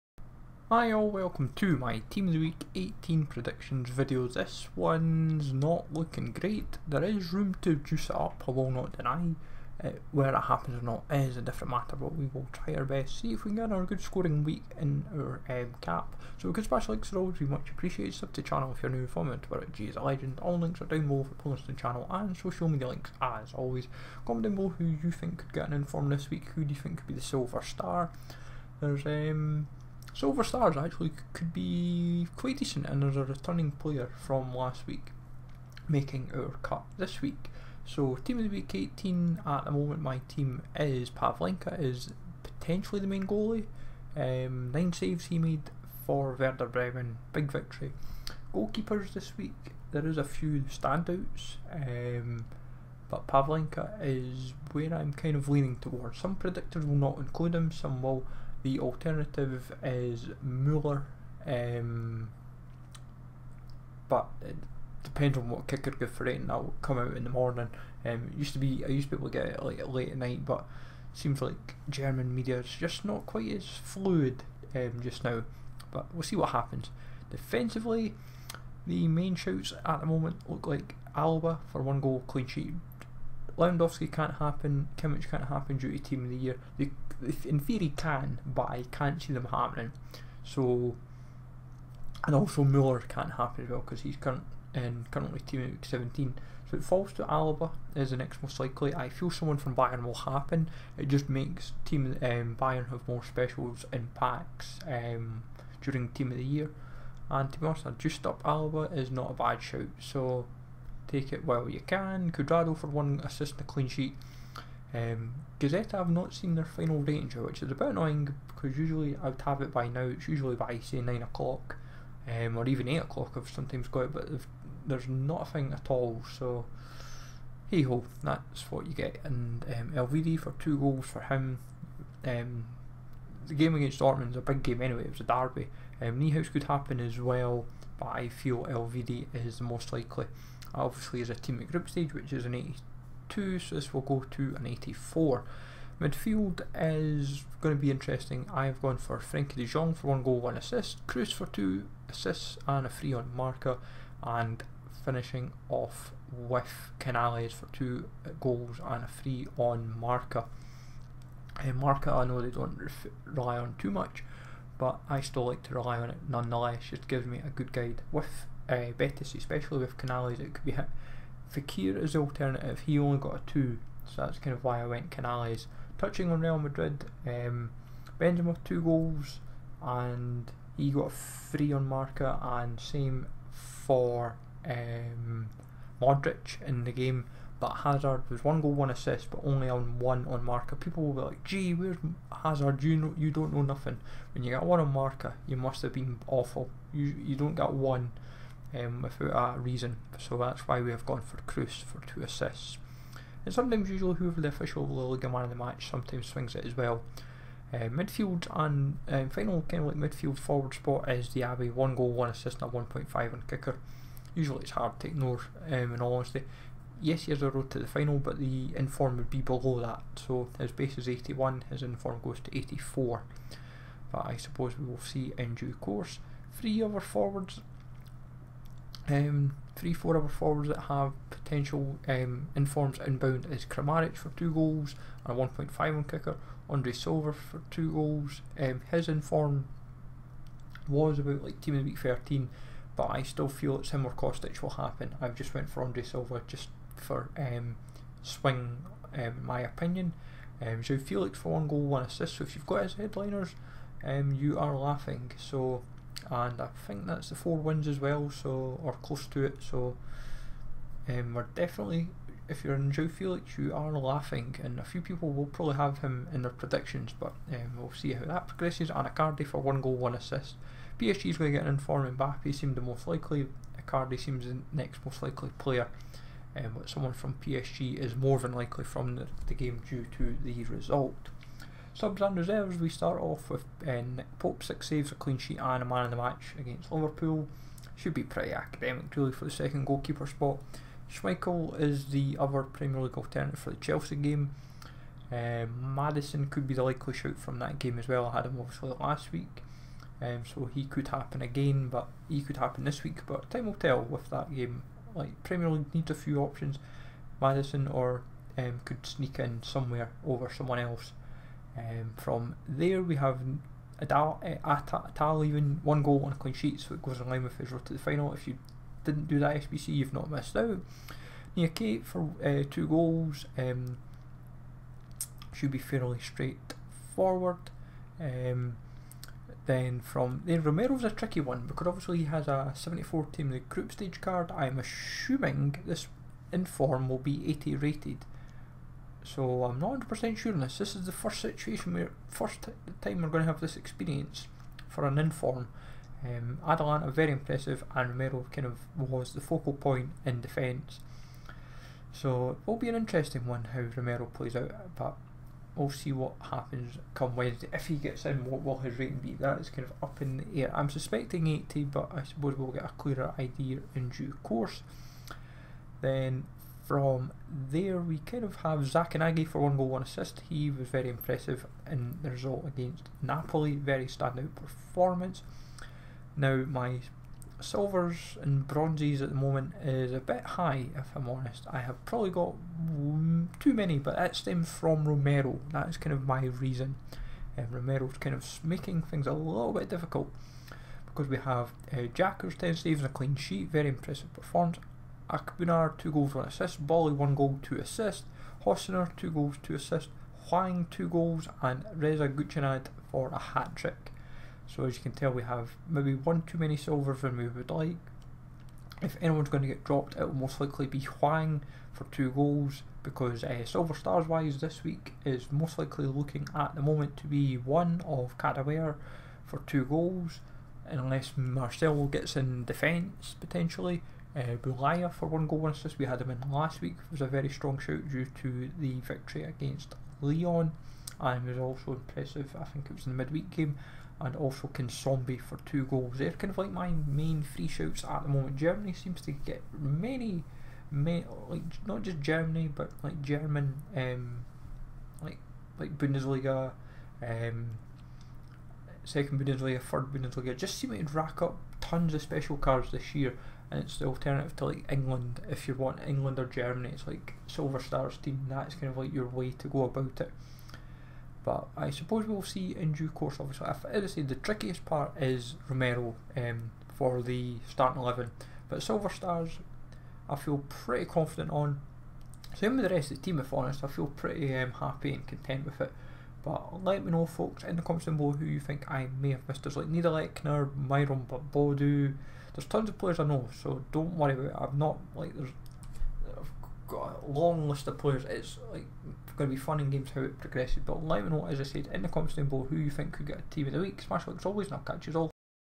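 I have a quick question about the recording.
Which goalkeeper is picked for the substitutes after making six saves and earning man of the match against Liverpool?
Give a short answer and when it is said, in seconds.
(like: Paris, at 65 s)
Nick Pope, at 284 s.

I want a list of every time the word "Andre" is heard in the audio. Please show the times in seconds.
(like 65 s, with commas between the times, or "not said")
236 s, 245 s.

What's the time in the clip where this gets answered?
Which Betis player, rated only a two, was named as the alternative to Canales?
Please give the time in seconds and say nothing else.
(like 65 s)
171 s.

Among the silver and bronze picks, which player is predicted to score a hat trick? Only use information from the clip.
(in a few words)
Reza Ghoochannejhad.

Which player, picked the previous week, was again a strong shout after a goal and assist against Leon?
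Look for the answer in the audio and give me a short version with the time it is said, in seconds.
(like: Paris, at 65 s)
Bulaya, at 424 s.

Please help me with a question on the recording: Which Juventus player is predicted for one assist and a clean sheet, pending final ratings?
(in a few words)
Cuadrado.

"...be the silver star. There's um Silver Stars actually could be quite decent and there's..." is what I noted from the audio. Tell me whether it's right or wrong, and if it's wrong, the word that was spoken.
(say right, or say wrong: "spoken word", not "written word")
right.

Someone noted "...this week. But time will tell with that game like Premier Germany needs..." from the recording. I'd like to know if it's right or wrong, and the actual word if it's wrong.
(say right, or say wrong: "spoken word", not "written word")
wrong: "League", not "Germany".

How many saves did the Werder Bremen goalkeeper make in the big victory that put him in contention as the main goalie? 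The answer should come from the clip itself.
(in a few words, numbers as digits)
9.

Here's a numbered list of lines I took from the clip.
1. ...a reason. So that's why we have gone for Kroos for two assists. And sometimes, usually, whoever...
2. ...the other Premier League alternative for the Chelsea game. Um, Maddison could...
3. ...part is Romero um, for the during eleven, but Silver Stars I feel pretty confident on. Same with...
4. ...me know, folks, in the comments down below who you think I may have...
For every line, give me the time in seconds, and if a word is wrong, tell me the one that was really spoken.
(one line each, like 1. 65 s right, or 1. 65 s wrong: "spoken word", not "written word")
1. 199 s right
2. 292 s right
3. 464 s wrong: "starting", not "during"
4. 477 s right.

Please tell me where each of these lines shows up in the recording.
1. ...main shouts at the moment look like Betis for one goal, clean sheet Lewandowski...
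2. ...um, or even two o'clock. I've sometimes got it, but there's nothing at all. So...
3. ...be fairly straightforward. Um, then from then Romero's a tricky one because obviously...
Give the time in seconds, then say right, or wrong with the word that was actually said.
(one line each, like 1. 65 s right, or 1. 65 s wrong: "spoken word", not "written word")
1. 79 s wrong: "Alaba", not "Betis"
2. 122 s wrong: "eight", not "two"
3. 325 s right.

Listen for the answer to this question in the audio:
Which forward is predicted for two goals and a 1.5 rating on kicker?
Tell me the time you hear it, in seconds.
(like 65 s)
233 s.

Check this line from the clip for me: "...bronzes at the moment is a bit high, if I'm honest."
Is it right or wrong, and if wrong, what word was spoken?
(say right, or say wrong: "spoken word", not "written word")
right.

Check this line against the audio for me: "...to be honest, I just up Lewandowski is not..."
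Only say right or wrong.
wrong.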